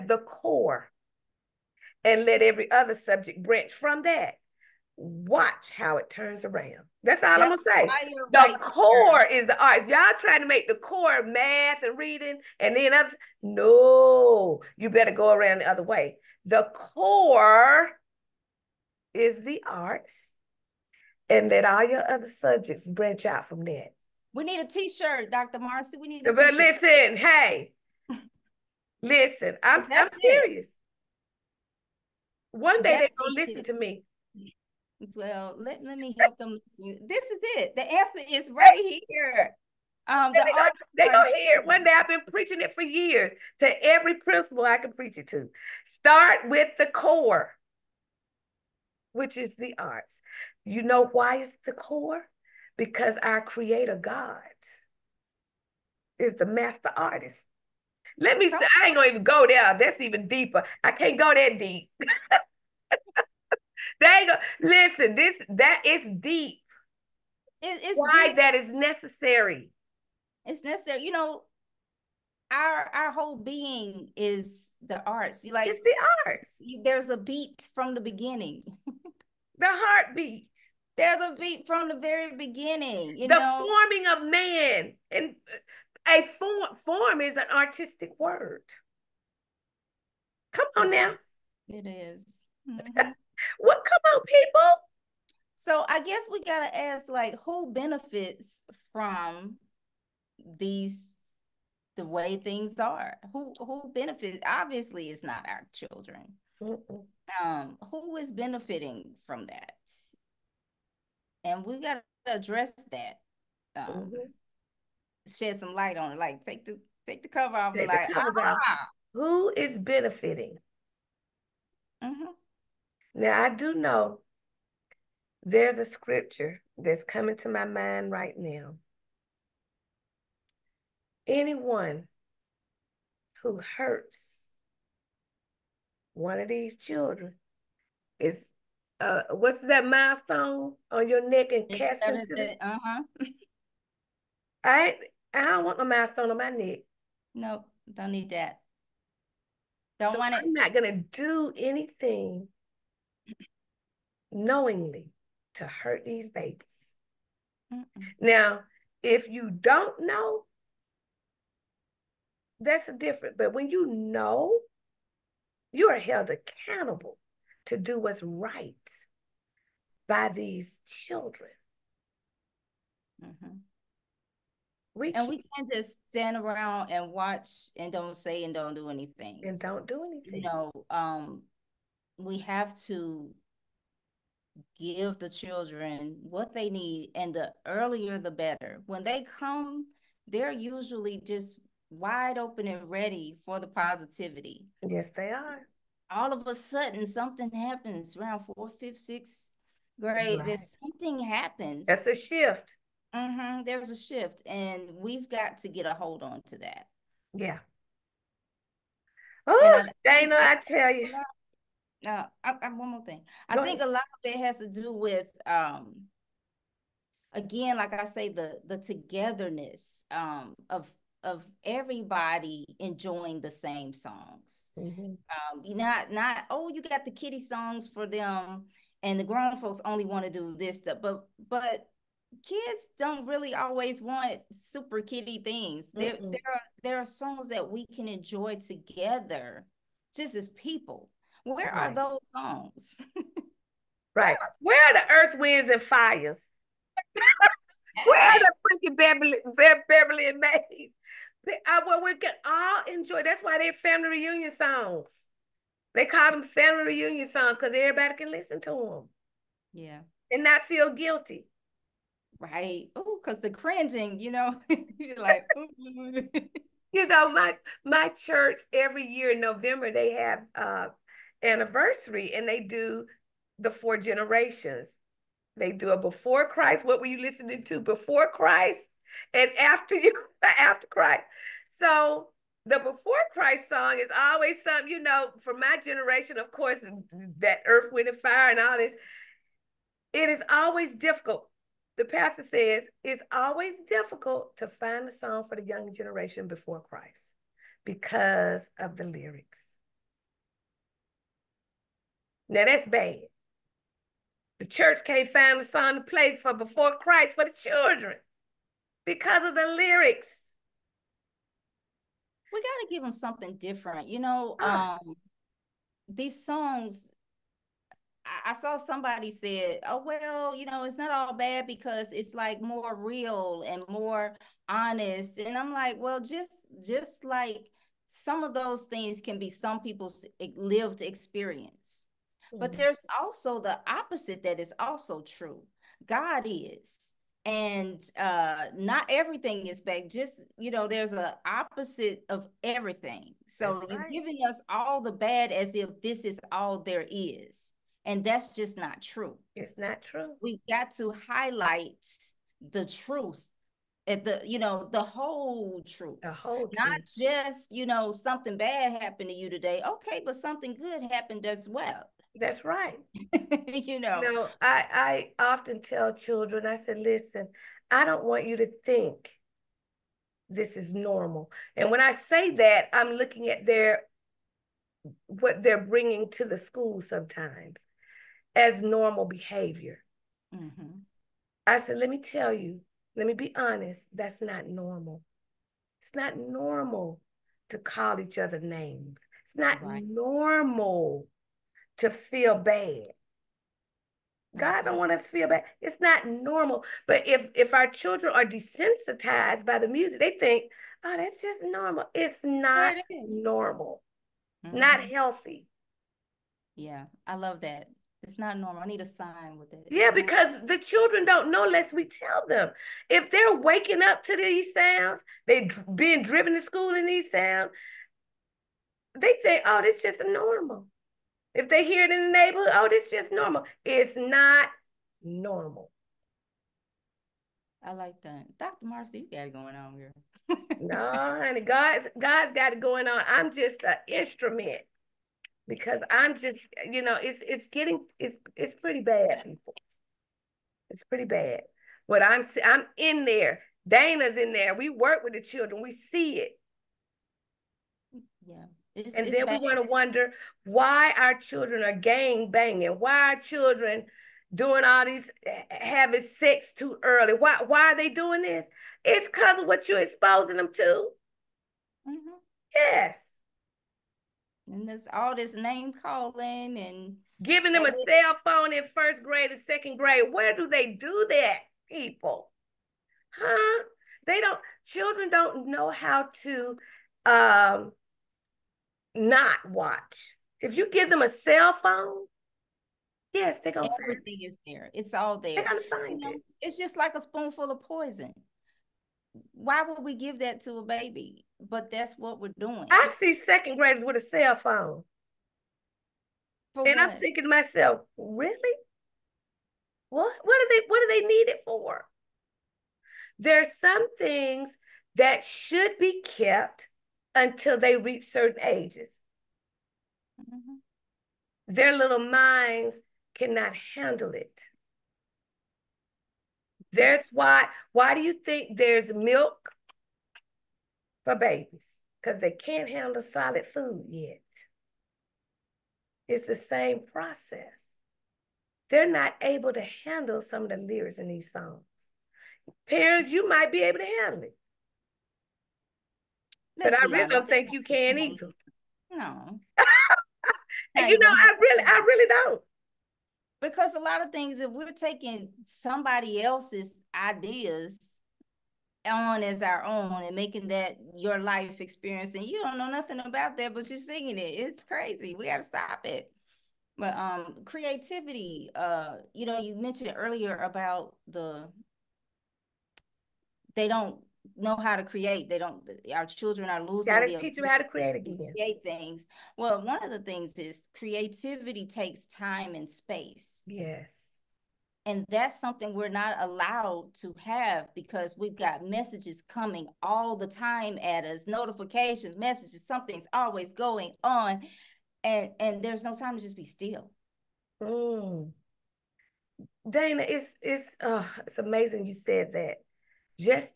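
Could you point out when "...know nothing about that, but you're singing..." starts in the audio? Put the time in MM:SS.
09:12.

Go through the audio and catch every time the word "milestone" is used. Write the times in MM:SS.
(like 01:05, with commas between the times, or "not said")
02:19, 02:25.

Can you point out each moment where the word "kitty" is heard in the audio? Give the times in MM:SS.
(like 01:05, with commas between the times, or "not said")
03:47, 03:55.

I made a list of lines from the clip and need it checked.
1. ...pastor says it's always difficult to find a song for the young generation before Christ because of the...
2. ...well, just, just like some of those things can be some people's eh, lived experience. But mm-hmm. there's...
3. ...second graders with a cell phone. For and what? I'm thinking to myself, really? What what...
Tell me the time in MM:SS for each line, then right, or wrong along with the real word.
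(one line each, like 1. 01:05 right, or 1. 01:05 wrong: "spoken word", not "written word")
1. 04:52 right
2. 05:25 right
3. 08:13 right.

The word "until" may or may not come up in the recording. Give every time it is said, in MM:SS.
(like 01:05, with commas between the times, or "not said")
08:27.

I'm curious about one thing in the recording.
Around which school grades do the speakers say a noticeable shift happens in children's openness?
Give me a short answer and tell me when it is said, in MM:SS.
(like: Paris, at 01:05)
fourth, fifth, sixth grade, at 03:18.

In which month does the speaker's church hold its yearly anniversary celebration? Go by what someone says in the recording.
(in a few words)
November.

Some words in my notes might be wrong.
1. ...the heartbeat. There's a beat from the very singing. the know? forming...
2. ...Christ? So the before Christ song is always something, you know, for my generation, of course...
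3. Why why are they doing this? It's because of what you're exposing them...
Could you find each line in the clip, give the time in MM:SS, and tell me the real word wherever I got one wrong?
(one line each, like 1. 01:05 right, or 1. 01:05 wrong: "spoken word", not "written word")
1. 01:19 wrong: "beginning", not "singing"
2. 04:40 right
3. 07:37 right.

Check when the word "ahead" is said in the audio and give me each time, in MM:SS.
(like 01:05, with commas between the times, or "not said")
03:33.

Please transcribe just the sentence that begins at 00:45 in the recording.
Start with the core, which is the arts.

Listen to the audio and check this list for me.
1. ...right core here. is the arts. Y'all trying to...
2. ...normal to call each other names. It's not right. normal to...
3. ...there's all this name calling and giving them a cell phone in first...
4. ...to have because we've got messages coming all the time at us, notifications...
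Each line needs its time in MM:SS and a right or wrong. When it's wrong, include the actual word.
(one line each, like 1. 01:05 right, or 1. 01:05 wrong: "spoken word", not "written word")
1. 00:08 right
2. 06:26 right
3. 07:44 right
4. 09:37 right.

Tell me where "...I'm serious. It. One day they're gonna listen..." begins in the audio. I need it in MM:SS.
00:30.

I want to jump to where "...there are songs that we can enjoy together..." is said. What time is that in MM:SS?
03:56.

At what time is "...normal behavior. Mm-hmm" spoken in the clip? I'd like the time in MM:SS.
06:18.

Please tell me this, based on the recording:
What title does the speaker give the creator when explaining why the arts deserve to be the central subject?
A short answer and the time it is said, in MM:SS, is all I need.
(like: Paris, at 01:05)
master artist, at 00:56.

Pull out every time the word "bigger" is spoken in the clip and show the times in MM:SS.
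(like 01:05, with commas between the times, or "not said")
not said.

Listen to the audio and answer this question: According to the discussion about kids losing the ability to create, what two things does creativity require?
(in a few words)
time and space.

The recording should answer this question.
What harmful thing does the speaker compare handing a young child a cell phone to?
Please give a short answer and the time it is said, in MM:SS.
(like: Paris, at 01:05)
spoonful of poison, at 08:07.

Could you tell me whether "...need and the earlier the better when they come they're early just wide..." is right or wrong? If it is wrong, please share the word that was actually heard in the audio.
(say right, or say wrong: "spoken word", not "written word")
wrong: "usually", not "early".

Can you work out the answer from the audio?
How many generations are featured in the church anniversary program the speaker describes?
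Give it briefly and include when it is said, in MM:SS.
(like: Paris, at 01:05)
four, at 04:33.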